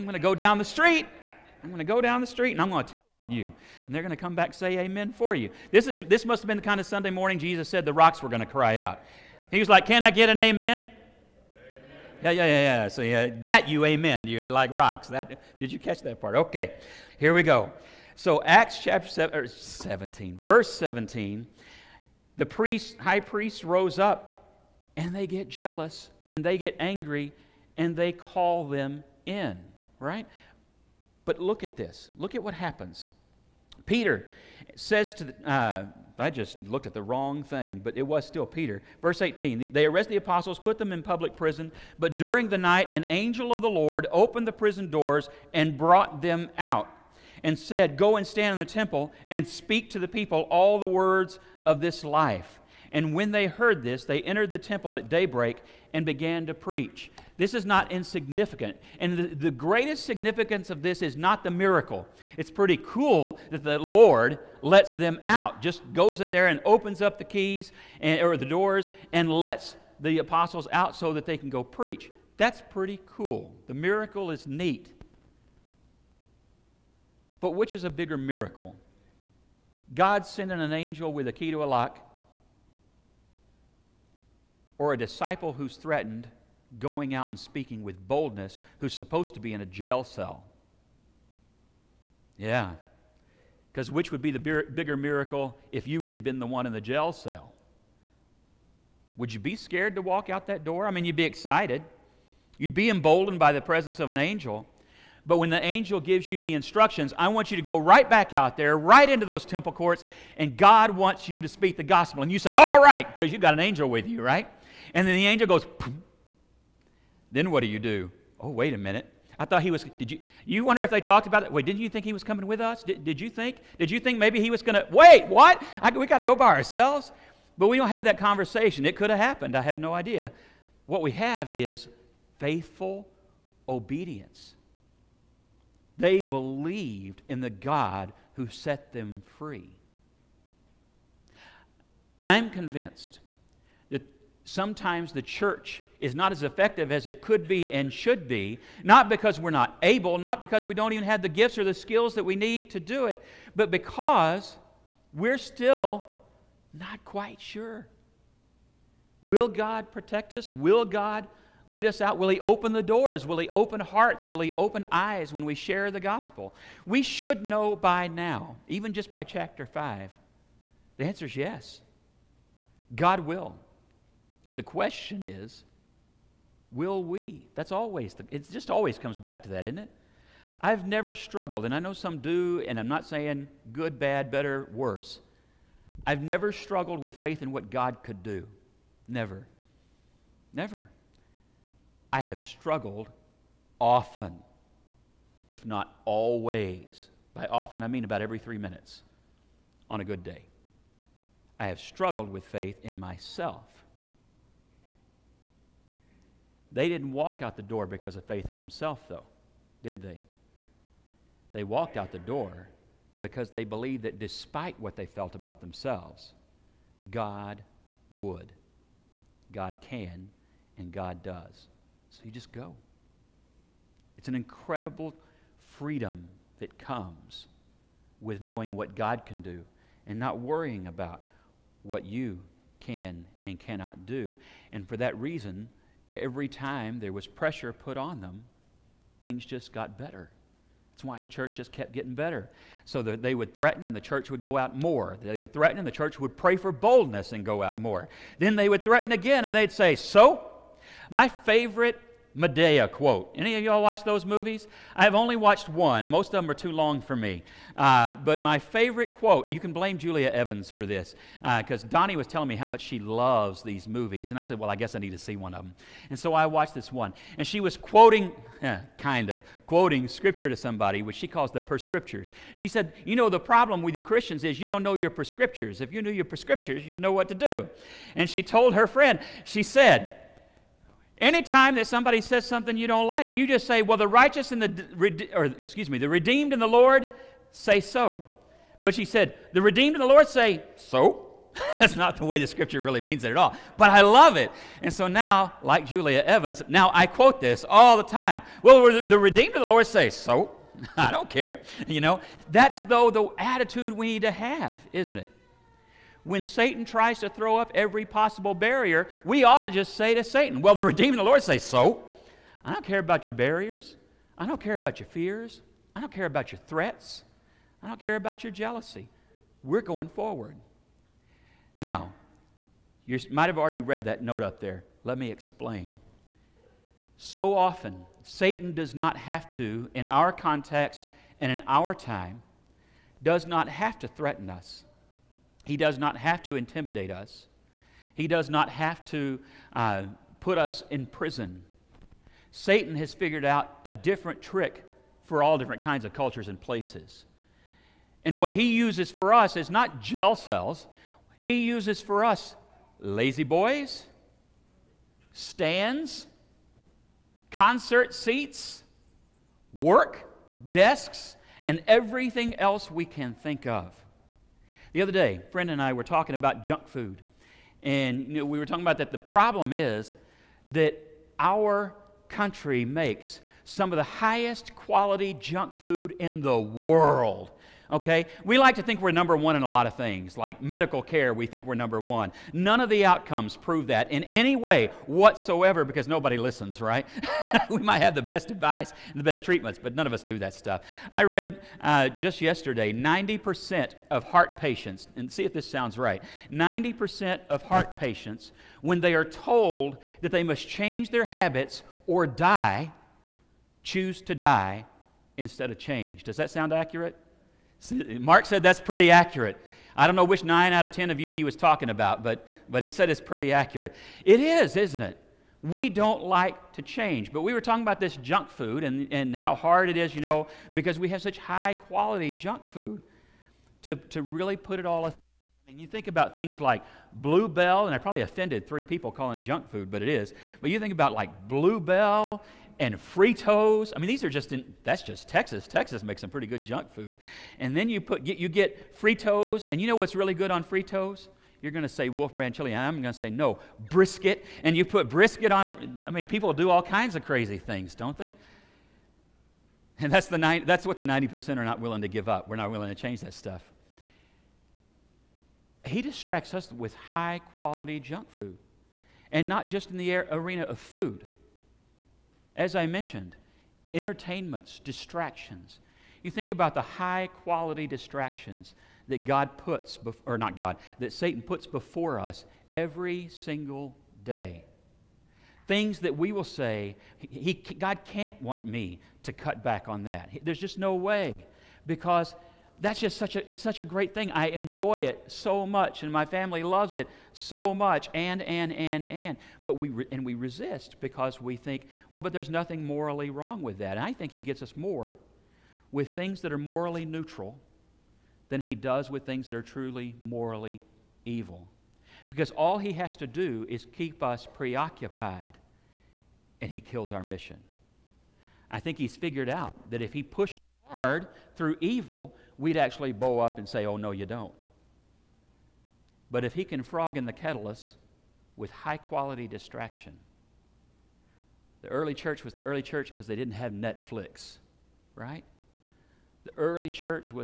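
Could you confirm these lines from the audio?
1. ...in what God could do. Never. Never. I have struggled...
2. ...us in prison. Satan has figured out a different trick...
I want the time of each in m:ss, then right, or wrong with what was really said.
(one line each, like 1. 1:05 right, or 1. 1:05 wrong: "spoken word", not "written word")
1. 3:07 right
2. 5:40 right.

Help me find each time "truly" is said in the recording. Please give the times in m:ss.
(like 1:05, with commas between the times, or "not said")
8:19.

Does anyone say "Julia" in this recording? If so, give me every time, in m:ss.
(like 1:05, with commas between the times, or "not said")
4:19, 4:55.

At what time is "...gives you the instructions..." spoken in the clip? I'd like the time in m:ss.
1:46.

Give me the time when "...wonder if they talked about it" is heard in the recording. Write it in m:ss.
2:00.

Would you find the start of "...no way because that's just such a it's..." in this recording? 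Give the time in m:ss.
8:00.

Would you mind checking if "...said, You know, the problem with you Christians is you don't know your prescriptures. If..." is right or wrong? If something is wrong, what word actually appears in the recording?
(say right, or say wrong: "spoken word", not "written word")
right.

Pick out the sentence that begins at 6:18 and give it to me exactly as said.
We like to think we're number one in a lot of things, like medical care, we think we're number one.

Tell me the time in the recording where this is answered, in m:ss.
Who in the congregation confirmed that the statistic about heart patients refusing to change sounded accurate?
6:48.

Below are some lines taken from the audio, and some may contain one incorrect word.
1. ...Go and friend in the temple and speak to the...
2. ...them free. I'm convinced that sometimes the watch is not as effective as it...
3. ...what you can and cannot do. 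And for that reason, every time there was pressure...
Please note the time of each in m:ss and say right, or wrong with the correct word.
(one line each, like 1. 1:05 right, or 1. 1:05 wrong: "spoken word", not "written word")
1. 0:47 wrong: "stand", not "friend"
2. 2:18 wrong: "church", not "watch"
3. 3:51 right.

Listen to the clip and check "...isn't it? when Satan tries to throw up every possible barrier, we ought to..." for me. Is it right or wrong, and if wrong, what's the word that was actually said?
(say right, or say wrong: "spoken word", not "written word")
right.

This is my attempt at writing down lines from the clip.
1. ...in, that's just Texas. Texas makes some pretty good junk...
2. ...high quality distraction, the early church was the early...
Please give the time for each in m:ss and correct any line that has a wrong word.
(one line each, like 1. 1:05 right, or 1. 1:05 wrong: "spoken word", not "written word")
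1. 7:14 right
2. 8:38 right.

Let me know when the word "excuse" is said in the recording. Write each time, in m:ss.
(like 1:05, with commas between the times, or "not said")
4:45.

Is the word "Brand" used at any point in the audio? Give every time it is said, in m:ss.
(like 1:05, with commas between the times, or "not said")
7:22.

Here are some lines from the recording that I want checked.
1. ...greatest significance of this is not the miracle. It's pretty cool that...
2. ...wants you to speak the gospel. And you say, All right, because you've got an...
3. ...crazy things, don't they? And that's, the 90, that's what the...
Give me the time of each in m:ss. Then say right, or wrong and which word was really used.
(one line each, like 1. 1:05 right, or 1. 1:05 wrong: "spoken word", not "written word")
1. 0:59 right
2. 1:50 right
3. 7:27 right.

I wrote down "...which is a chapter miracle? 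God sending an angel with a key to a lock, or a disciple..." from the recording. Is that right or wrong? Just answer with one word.
wrong.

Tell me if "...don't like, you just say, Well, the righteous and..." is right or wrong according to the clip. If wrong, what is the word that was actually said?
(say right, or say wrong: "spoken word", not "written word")
right.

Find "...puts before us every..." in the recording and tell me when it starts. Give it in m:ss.
7:51.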